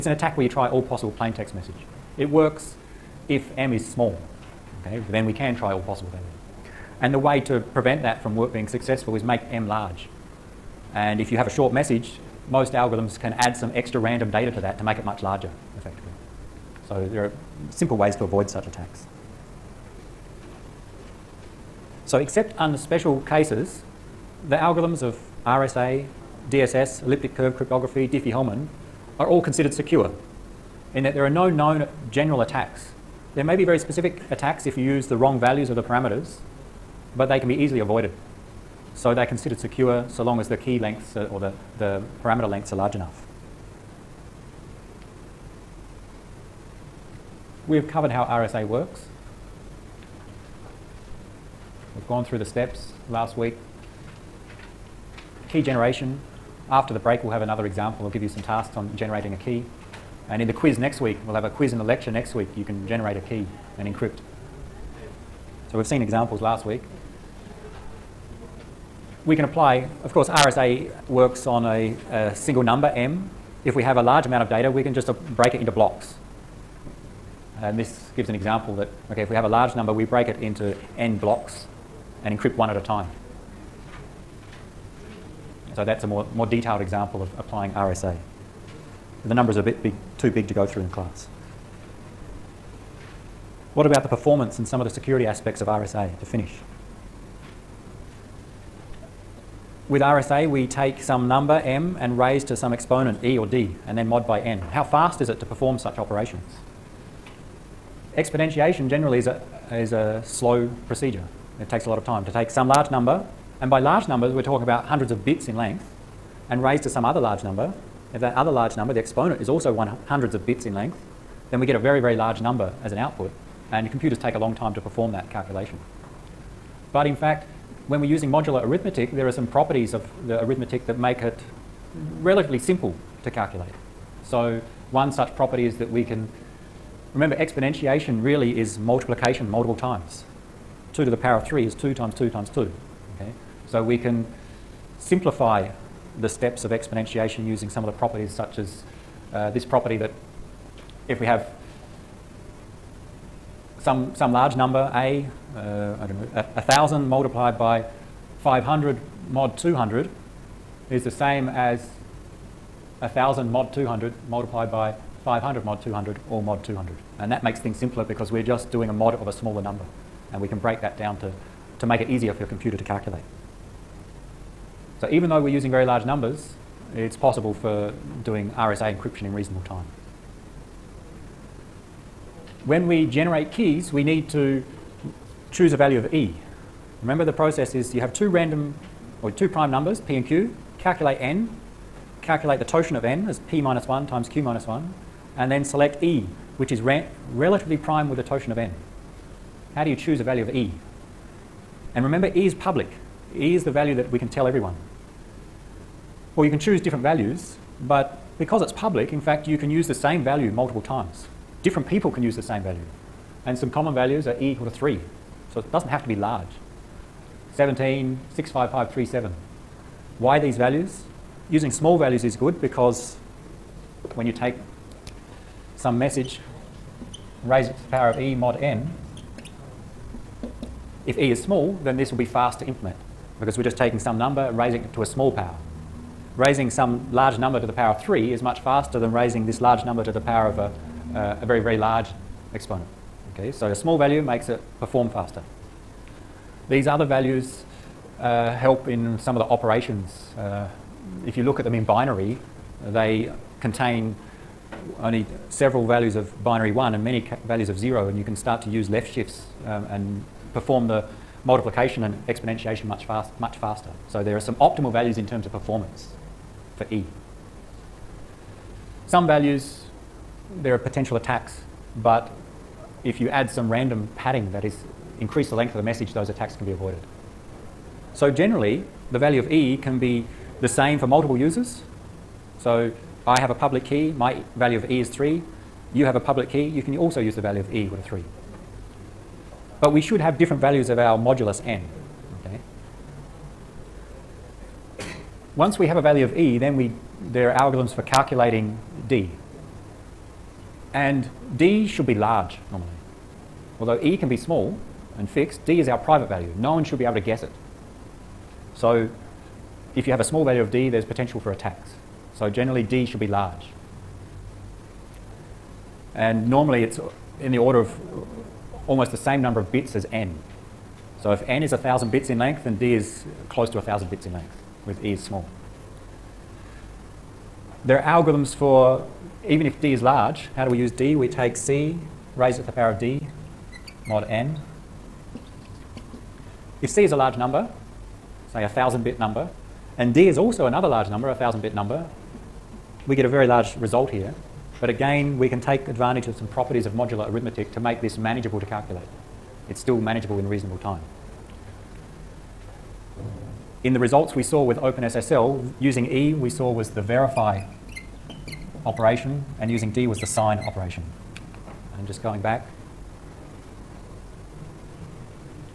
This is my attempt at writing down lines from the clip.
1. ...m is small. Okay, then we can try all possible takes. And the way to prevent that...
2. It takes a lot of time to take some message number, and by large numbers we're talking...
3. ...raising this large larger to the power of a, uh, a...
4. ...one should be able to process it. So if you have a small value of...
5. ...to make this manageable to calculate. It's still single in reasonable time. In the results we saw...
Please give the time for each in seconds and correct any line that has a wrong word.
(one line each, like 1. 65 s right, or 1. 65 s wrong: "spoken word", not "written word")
1. 3 s wrong: "values", not "takes"
2. 111 s wrong: "large", not "message"
3. 239 s wrong: "number", not "larger"
4. 306 s wrong: "guess", not "process"
5. 347 s wrong: "manageable", not "single".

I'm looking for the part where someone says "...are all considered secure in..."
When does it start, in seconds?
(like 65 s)
29 s.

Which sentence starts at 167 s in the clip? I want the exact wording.
And that makes things simpler because we're just doing a mod of a smaller number.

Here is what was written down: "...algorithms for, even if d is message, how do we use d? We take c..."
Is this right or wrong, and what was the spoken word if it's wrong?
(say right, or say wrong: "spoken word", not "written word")
wrong: "large", not "message".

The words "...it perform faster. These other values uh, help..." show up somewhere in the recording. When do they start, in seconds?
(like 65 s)
244 s.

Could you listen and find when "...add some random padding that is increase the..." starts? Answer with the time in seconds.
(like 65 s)
273 s.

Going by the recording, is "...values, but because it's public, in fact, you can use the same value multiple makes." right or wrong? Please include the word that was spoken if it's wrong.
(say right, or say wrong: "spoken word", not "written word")
wrong: "times", not "makes".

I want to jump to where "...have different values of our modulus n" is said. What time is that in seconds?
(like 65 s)
290 s.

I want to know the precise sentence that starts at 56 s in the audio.
After the break, we'll have another example.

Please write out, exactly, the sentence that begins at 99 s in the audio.
With RSA, we take some number, m, and raise to some exponent, e or d, and then mod by n.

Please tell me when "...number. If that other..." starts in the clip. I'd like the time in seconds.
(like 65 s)
117 s.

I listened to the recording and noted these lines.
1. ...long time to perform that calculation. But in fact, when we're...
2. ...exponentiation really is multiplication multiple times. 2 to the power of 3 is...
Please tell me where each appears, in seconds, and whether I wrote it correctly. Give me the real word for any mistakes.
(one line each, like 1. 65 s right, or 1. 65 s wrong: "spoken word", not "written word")
1. 124 s right
2. 137 s right.